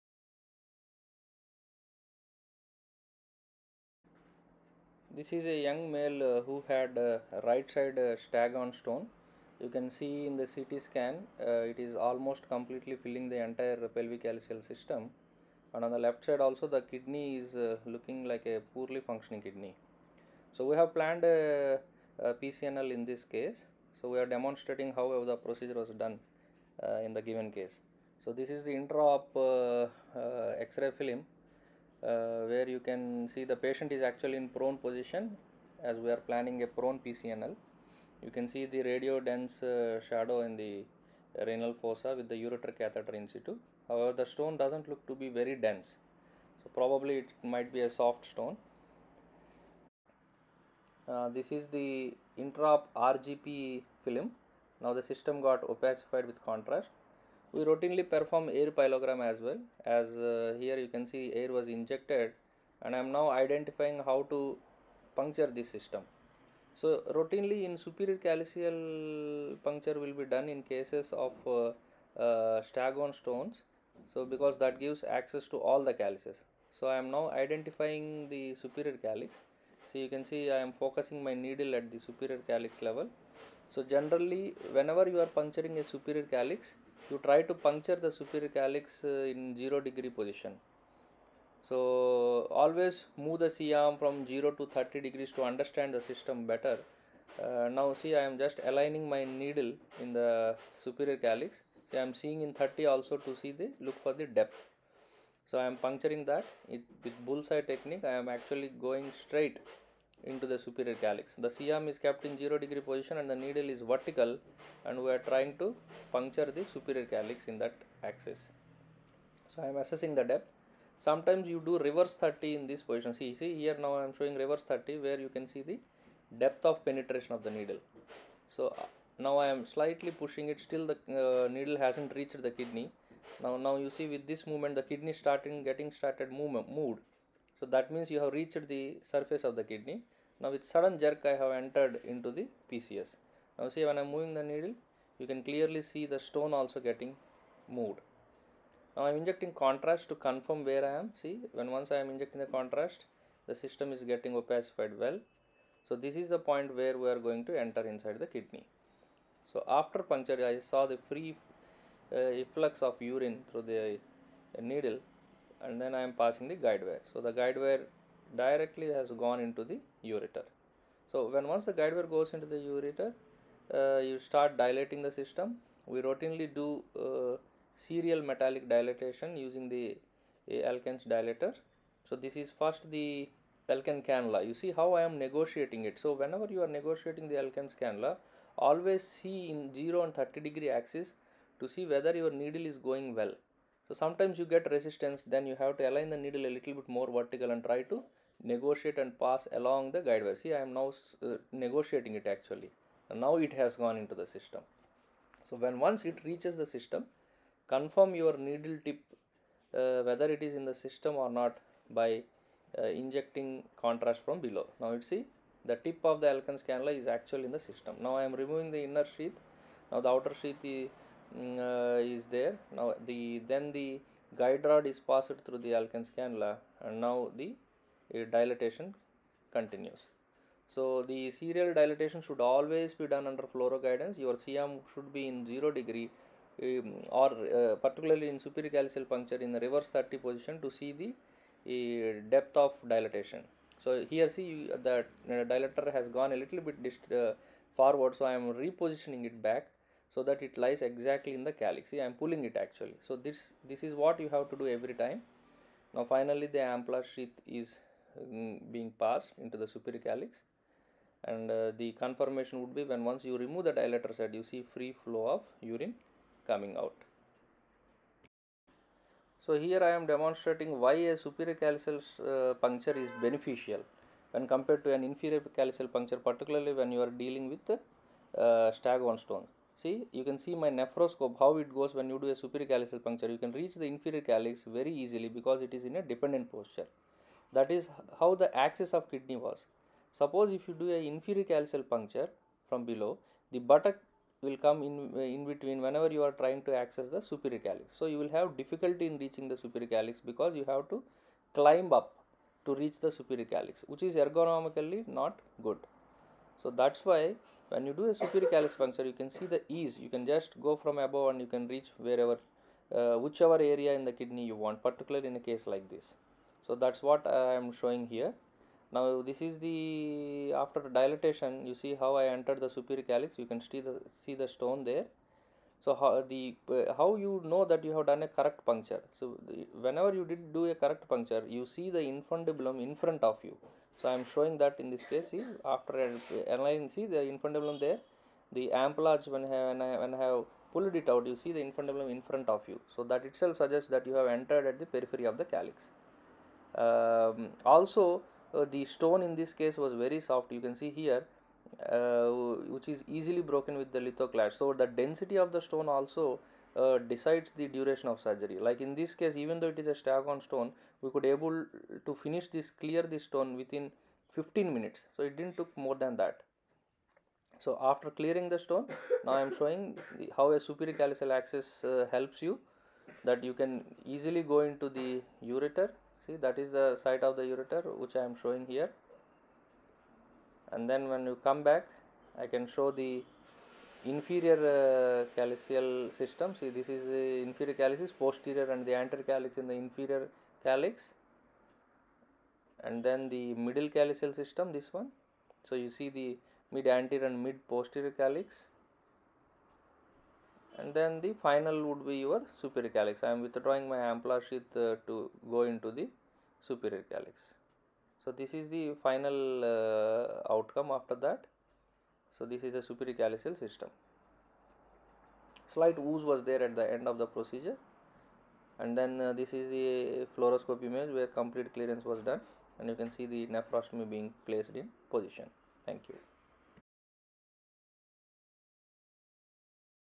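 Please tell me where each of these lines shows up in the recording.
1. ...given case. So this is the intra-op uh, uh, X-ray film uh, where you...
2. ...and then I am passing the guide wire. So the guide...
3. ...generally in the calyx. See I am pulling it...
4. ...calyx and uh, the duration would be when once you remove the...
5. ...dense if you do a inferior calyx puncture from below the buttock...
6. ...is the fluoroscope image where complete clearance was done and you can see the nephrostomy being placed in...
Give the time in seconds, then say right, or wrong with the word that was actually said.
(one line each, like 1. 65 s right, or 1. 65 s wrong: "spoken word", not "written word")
1. 27 s right
2. 165 s right
3. 250 s wrong: "exactly", not "generally"
4. 260 s wrong: "confirmation", not "duration"
5. 290 s wrong: "suppose", not "dense"
6. 419 s right.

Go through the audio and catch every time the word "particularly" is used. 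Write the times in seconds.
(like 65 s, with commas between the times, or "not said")
237 s, 276 s, 314 s.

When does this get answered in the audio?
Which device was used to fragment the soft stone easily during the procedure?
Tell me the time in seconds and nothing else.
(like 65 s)
353 s.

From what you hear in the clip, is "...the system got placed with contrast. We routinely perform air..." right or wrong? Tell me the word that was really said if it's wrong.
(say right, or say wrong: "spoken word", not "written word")
wrong: "opacified", not "placed".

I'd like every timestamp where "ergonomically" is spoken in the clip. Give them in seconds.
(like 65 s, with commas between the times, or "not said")
304 s.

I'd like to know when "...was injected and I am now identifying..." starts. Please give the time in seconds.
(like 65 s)
61 s.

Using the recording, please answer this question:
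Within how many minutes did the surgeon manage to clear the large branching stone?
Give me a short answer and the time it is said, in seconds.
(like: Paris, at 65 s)
15, at 364 s.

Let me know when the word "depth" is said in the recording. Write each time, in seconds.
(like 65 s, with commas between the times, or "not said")
104 s, 120 s, 126 s, 242 s.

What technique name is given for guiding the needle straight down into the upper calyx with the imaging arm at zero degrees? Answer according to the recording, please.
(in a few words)
Bullseye technique.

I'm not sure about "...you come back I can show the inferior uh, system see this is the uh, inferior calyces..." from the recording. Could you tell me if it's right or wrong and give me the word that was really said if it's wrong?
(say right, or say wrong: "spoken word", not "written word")
right.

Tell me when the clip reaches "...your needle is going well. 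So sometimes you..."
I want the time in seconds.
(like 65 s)
192 s.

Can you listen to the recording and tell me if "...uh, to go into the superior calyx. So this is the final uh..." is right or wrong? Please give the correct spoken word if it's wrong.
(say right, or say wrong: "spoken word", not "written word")
right.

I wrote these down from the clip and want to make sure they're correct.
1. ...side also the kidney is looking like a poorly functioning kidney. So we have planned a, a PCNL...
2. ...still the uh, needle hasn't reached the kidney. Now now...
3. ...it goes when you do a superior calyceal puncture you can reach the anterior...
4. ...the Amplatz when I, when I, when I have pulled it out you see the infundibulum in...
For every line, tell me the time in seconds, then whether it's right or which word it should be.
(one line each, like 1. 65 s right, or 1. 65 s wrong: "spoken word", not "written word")
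1. 16 s right
2. 130 s right
3. 281 s wrong: "inferior", not "anterior"
4. 338 s right.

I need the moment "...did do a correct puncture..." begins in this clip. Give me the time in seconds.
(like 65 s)
330 s.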